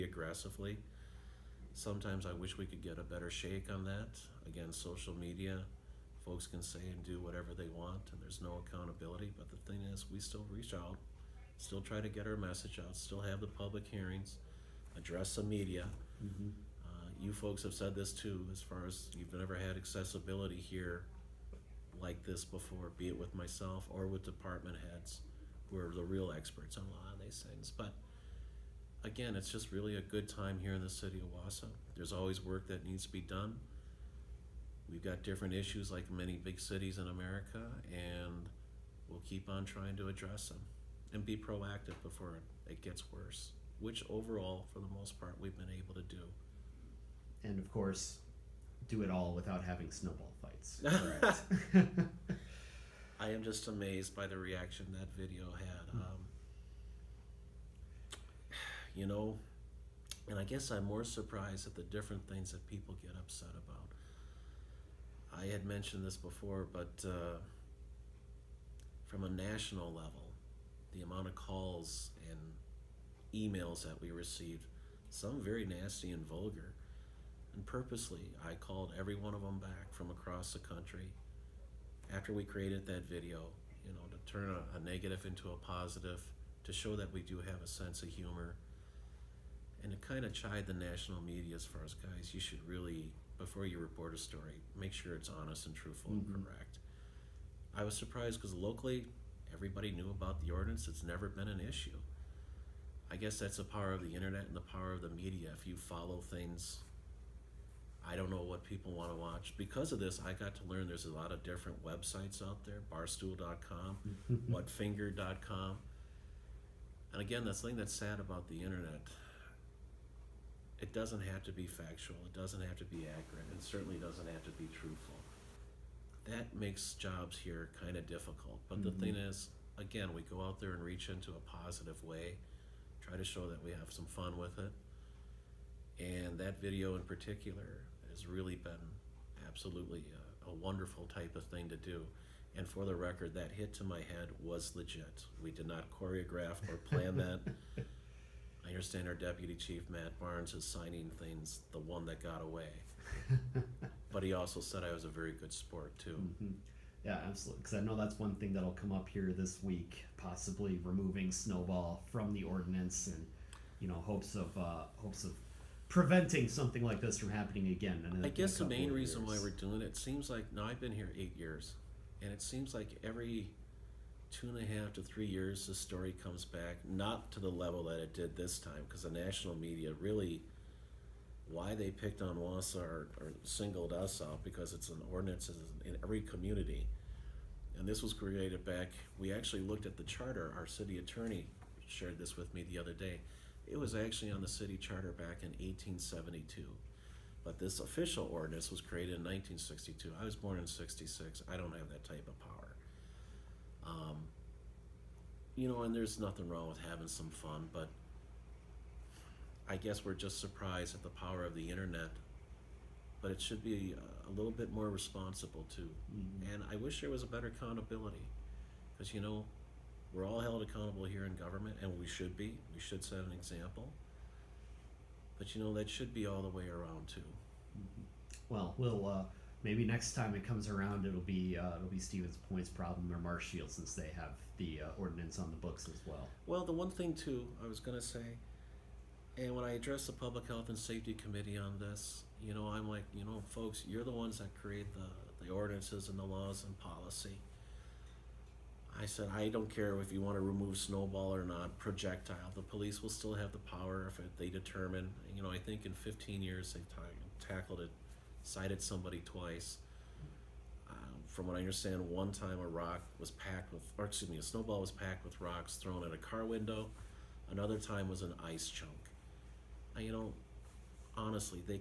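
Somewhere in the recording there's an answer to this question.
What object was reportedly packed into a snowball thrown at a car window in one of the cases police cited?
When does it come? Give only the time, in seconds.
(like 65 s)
265 s.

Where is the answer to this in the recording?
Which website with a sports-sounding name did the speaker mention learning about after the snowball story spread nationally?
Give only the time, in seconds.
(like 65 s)
112 s.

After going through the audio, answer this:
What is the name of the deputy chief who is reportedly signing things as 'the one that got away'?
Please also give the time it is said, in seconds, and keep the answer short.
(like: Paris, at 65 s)
Matt Barnes, at 149 s.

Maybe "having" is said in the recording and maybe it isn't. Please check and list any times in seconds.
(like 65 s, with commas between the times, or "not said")
49 s, 206 s.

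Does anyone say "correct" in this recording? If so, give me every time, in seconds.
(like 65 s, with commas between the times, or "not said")
50 s, 96 s.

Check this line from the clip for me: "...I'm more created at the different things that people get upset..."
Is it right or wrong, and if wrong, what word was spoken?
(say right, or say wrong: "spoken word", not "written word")
wrong: "surprised", not "created".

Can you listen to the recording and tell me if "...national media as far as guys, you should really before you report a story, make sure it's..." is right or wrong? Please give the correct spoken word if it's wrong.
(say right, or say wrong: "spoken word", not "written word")
right.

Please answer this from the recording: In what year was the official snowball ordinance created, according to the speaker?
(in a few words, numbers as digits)
1962.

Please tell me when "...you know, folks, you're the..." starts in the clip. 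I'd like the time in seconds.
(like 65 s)
243 s.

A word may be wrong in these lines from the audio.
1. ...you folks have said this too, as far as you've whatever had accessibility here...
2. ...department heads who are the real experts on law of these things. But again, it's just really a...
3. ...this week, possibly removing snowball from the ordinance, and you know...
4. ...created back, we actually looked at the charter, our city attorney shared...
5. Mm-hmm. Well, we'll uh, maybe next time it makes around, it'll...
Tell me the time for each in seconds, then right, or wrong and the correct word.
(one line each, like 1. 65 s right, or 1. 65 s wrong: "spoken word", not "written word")
1. 17 s wrong: "never", not "whatever"
2. 24 s right
3. 159 s right
4. 188 s right
5. 227 s wrong: "comes", not "makes".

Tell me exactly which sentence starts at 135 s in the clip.
And that video in particular has really been absolutely a, a, wonderful type of thing to do.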